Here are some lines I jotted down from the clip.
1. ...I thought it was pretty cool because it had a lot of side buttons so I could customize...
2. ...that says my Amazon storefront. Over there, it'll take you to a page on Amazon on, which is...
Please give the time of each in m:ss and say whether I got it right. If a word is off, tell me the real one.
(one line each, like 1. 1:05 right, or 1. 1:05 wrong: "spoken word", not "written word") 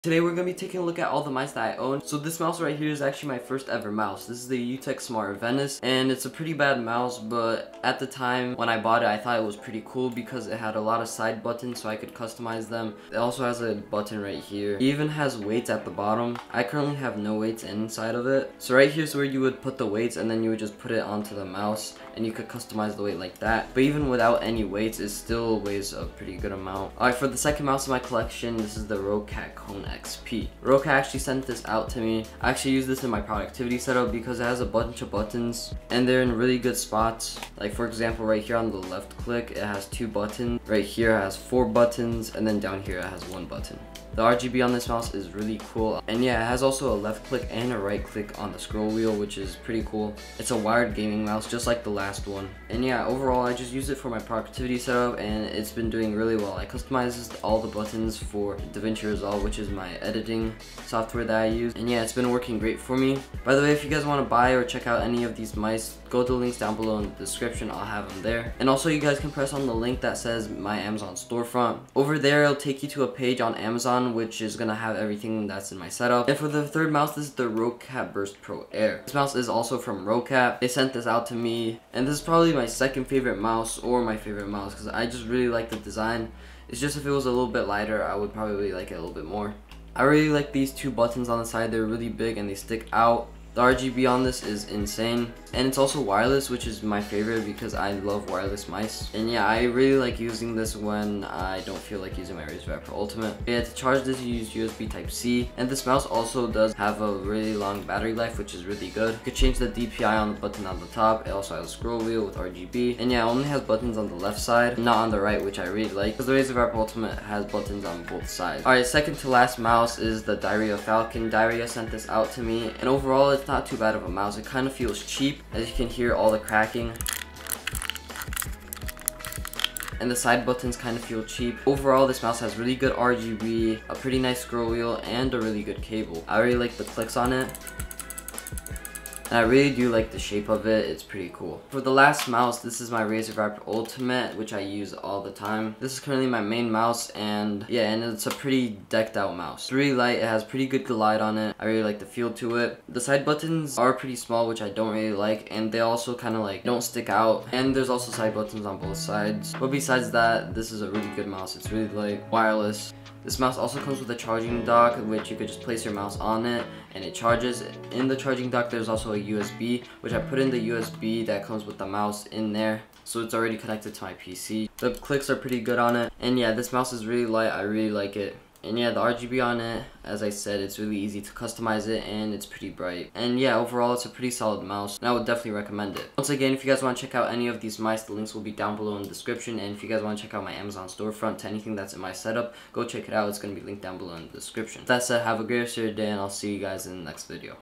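1. 0:09 right
2. 1:10 right.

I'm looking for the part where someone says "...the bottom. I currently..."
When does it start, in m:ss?
0:15.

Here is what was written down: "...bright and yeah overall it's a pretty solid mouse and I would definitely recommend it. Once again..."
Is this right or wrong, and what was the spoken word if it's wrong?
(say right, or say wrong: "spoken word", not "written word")
right.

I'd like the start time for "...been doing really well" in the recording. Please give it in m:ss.
0:55.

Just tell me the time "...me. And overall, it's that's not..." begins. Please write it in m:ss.
2:02.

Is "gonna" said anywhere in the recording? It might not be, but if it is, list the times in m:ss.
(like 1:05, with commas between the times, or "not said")
1:14.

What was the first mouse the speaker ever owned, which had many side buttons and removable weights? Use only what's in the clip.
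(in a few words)
UTech Smart Venus.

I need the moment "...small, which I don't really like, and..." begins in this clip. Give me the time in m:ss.
2:34.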